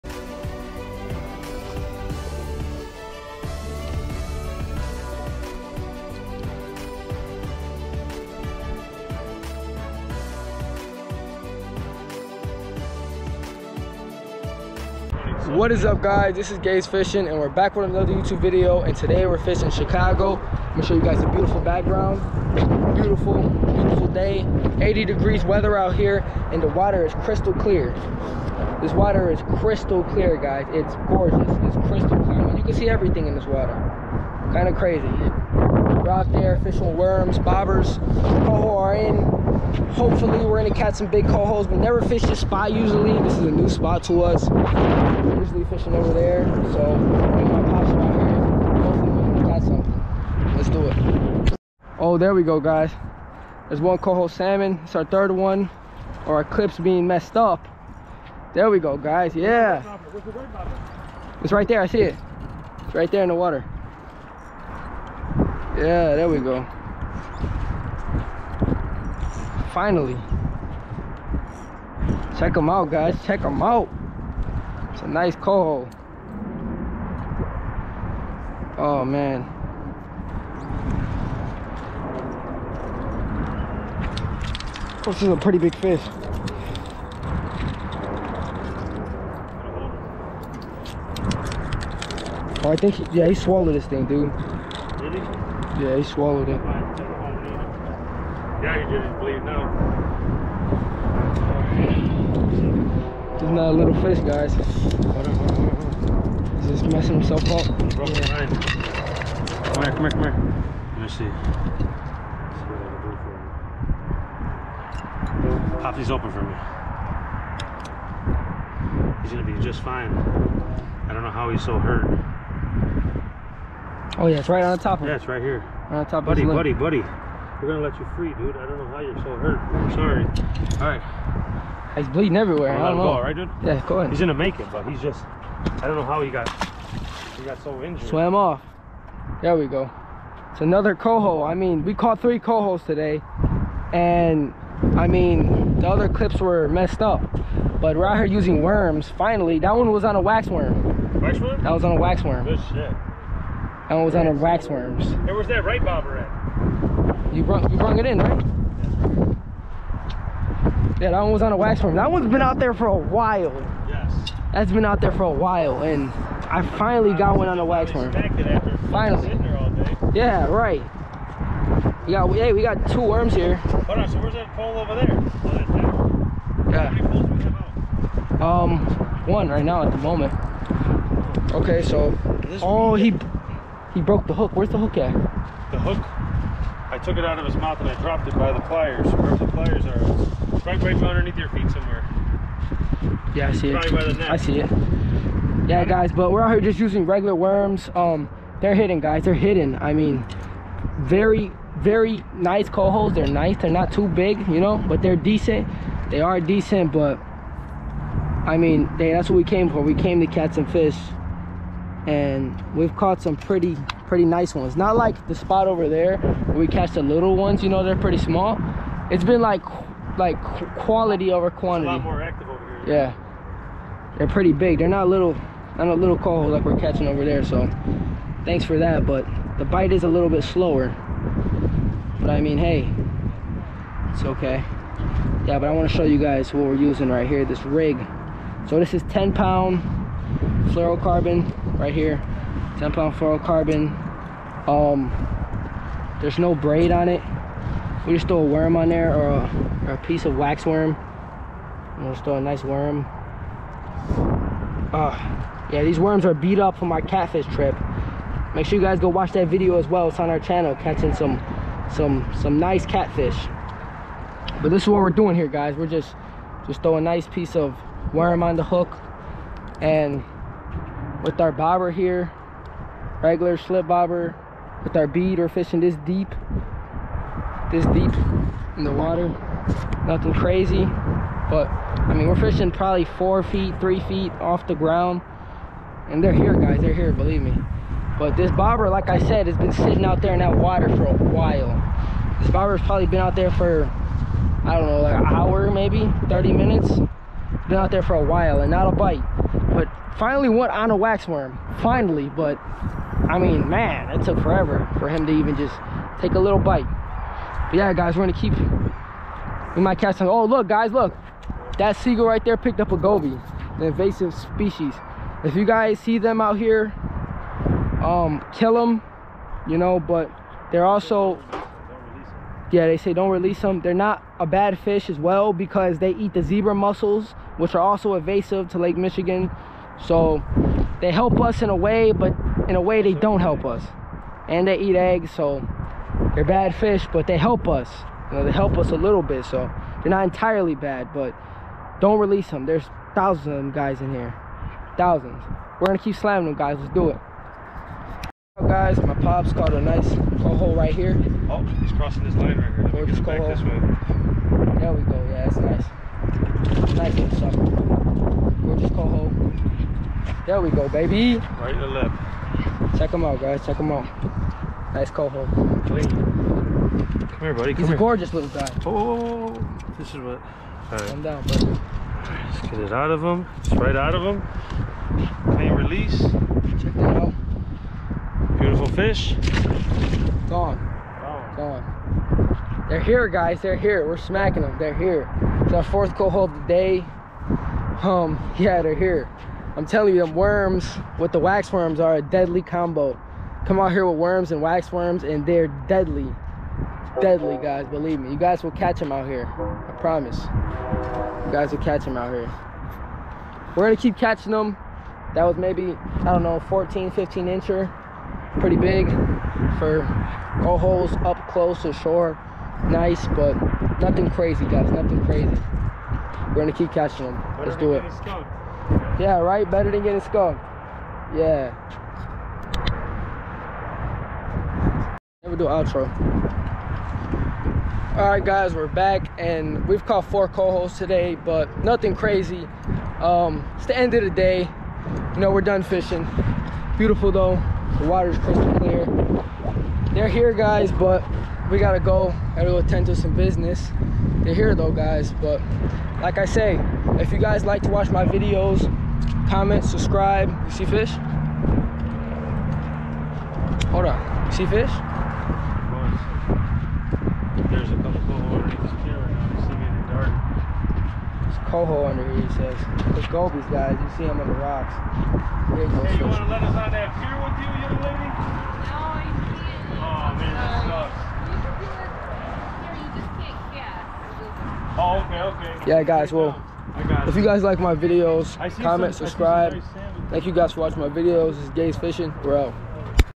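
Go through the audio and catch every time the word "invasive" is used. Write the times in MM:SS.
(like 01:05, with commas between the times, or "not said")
05:13, 05:28.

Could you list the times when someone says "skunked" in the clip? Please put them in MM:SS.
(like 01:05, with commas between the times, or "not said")
07:00.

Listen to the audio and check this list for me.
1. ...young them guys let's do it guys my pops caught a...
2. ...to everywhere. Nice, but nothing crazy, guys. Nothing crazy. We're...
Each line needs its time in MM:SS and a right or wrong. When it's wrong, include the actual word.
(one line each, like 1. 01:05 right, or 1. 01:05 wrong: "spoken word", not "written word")
1. 05:46 wrong: "slamming", not "young"
2. 06:51 wrong: "shore", not "everywhere".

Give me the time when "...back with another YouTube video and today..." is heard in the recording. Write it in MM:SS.
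00:17.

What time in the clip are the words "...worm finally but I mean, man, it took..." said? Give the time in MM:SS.
05:01.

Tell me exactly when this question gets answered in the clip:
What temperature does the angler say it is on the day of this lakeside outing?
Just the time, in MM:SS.
00:24.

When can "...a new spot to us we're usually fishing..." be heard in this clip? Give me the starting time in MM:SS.
00:43.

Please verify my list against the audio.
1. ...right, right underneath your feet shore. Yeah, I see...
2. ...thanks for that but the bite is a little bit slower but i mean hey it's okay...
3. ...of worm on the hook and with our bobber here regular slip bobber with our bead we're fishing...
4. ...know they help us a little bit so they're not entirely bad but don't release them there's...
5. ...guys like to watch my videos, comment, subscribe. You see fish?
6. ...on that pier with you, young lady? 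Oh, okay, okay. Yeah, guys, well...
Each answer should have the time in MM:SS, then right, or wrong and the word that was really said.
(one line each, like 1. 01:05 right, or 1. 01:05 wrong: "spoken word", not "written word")
1. 03:10 wrong: "somewhere", not "shore"
2. 03:48 right
3. 04:27 right
4. 05:38 right
5. 07:27 right
6. 07:46 right.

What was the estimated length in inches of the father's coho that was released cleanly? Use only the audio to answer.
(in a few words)
14, 15 inches.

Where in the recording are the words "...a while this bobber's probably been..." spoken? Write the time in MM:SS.
04:51.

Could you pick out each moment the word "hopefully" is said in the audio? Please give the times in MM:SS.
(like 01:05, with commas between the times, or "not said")
00:39, 00:48.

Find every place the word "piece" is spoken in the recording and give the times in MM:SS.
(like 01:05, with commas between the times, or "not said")
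04:09, 04:27.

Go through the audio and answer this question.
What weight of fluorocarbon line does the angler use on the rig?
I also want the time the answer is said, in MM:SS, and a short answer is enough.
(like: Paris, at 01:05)
10 pound, at 03:59.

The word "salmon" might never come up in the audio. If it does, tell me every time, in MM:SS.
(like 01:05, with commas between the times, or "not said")
00:54.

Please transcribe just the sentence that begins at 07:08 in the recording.
Alright guys, we're back and we've caught four cohos today, but nothing crazy.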